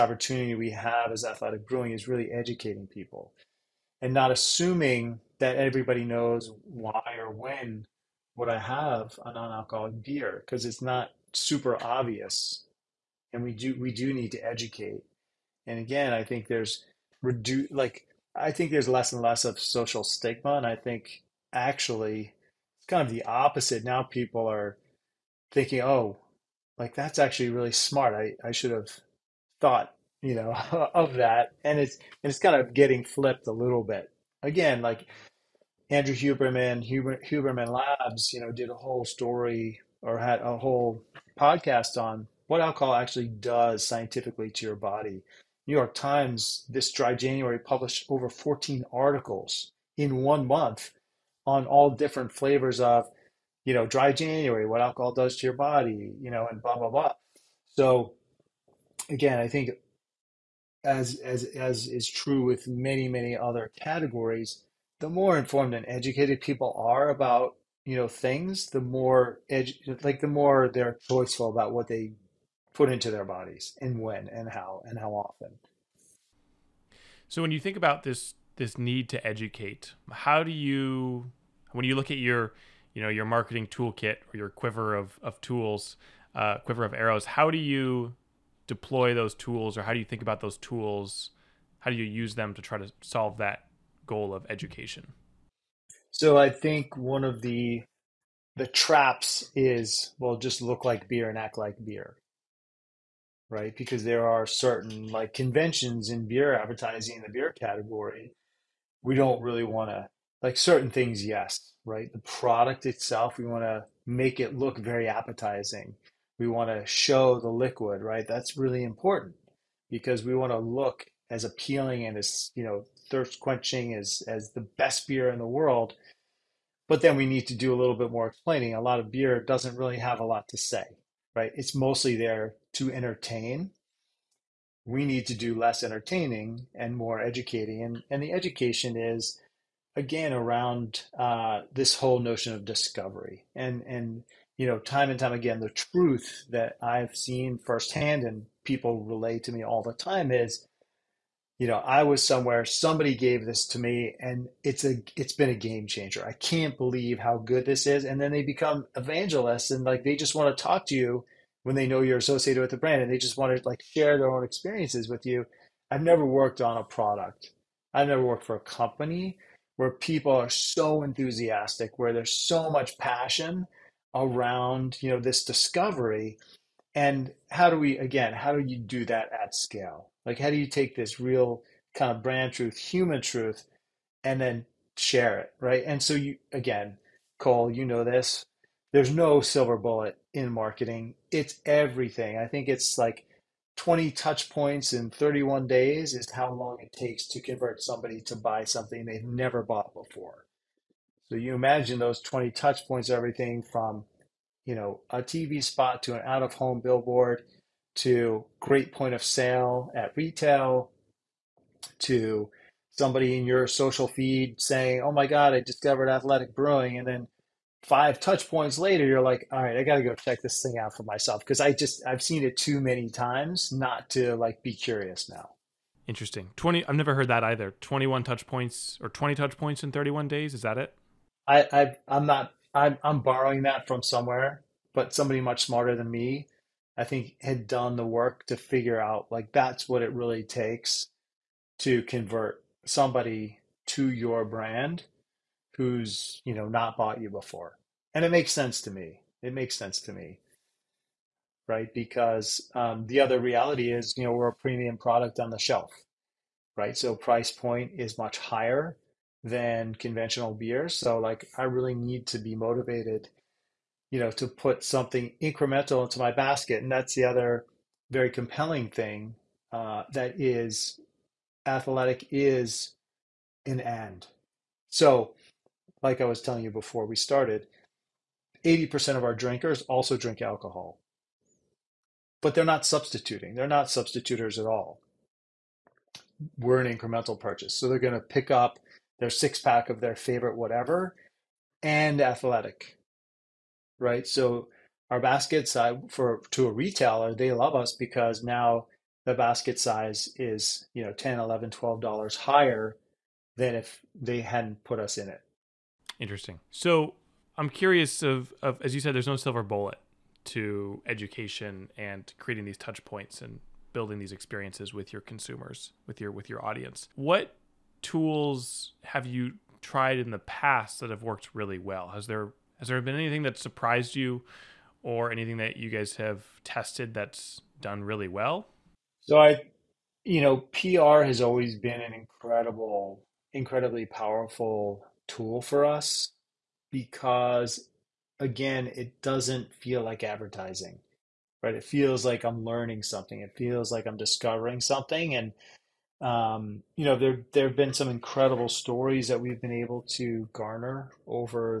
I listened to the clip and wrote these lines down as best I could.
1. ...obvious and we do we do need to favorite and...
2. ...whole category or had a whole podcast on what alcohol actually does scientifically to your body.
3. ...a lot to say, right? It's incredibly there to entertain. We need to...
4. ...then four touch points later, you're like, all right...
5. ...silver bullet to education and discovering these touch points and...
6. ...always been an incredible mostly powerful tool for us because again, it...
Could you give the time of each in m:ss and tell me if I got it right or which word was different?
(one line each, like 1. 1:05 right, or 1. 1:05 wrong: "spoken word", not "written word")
1. 0:11 wrong: "educate", not "favorite"
2. 0:38 wrong: "story", not "category"
3. 2:10 wrong: "mostly", not "incredibly"
4. 3:37 wrong: "five", not "four"
5. 5:09 wrong: "creating", not "discovering"
6. 5:31 wrong: "incredibly", not "mostly".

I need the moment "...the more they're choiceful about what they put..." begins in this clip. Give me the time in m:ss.
1:10.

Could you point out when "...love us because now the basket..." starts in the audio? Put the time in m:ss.
4:57.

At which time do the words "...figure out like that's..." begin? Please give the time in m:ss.
3:58.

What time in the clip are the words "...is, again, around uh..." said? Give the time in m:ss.
2:18.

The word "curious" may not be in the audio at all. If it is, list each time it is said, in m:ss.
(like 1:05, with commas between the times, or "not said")
3:44, 5:07.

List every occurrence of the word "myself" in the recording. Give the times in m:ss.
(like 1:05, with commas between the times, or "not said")
3:41.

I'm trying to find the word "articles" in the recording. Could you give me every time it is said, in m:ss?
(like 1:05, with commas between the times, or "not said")
0:48.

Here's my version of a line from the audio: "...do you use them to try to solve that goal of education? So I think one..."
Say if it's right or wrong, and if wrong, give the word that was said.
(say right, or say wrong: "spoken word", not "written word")
right.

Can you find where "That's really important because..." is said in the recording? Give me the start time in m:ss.
1:58.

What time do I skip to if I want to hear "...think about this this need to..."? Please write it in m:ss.
1:17.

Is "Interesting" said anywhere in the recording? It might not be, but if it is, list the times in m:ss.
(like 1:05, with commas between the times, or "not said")
3:46, 5:06.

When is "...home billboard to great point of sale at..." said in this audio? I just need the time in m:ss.
3:26.